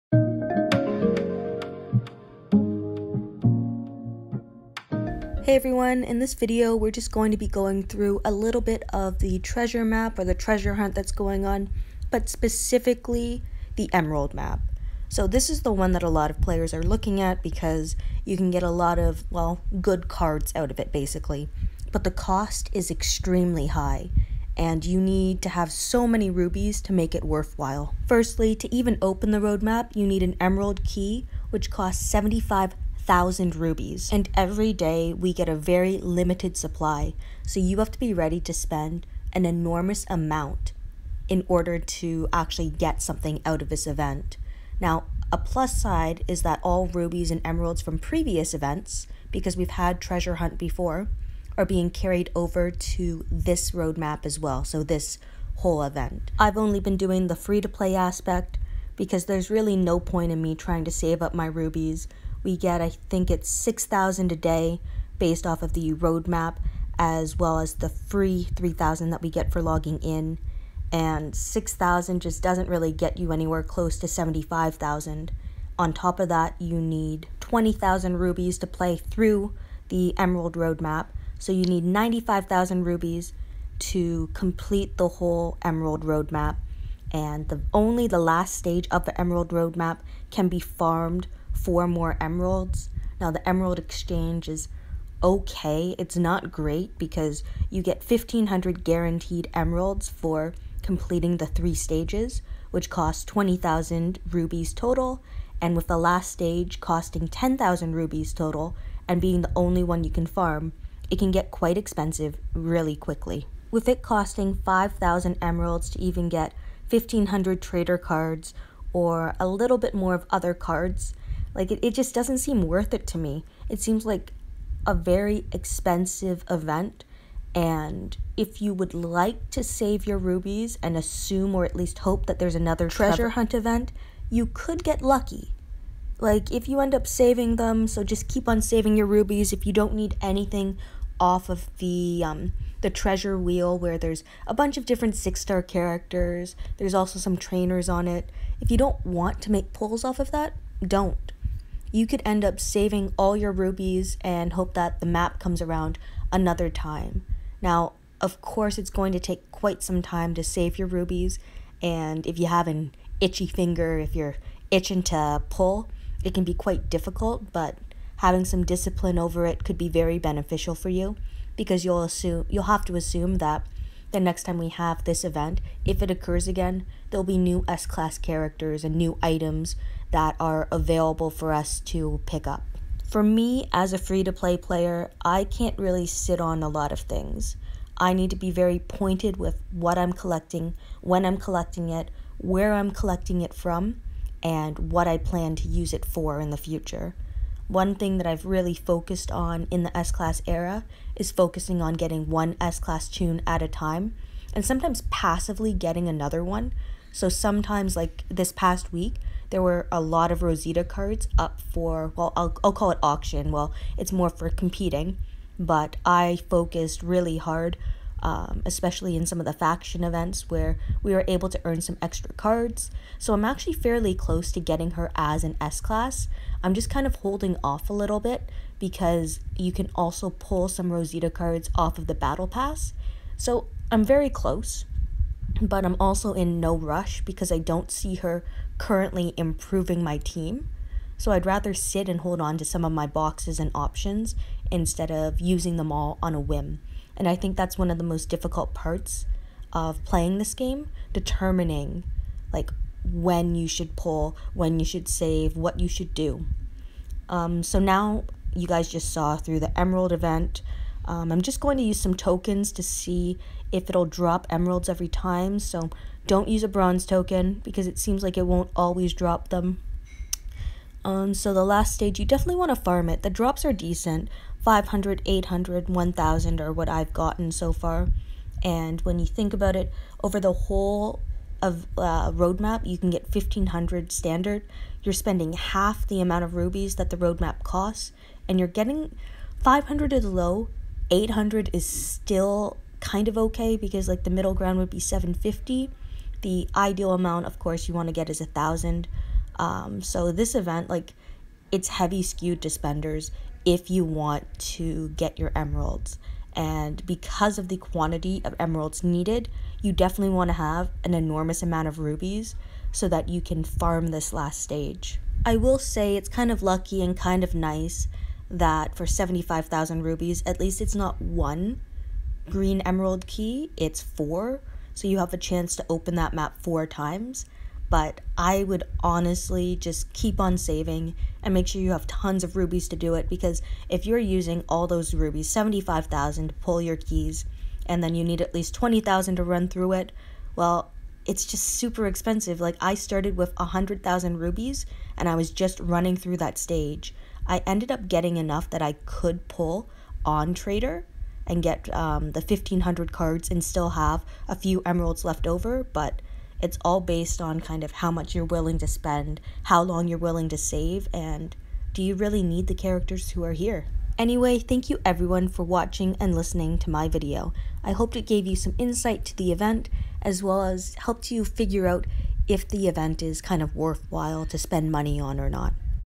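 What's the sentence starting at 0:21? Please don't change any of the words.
But the cost is extremely high and you need to have so many rubies to make it worthwhile.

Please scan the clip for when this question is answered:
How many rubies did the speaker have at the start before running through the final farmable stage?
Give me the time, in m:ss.
5:43.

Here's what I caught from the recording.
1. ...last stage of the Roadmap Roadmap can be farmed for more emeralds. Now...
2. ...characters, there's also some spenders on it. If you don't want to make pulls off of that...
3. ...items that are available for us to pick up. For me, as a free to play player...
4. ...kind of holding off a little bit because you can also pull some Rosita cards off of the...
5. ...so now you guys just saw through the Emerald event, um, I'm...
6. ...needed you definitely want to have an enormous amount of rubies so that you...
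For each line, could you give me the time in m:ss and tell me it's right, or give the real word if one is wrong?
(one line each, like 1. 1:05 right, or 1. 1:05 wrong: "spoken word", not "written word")
1. 1:28 wrong: "Emerald", not "Roadmap"
2. 2:25 wrong: "trainers", not "spenders"
3. 2:59 right
4. 3:46 right
5. 4:17 right
6. 5:09 right.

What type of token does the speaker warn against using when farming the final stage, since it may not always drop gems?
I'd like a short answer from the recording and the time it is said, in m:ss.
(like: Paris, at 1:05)
bronze token, at 4:26.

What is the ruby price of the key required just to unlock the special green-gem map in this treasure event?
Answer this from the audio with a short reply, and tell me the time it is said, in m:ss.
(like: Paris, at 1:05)
75,000 rubies, at 0:32.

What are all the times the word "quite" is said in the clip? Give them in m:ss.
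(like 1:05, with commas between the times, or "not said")
1:51, 2:39, 2:46.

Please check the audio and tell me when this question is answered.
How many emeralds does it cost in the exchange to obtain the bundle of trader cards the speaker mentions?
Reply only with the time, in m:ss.
1:54.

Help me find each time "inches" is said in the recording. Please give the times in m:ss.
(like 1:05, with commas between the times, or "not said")
not said.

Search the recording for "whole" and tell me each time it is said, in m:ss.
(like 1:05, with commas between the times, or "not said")
0:55, 1:25, 4:40.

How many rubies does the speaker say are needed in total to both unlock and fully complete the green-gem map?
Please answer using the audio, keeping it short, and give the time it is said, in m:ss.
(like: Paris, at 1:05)
95,000, at 1:21.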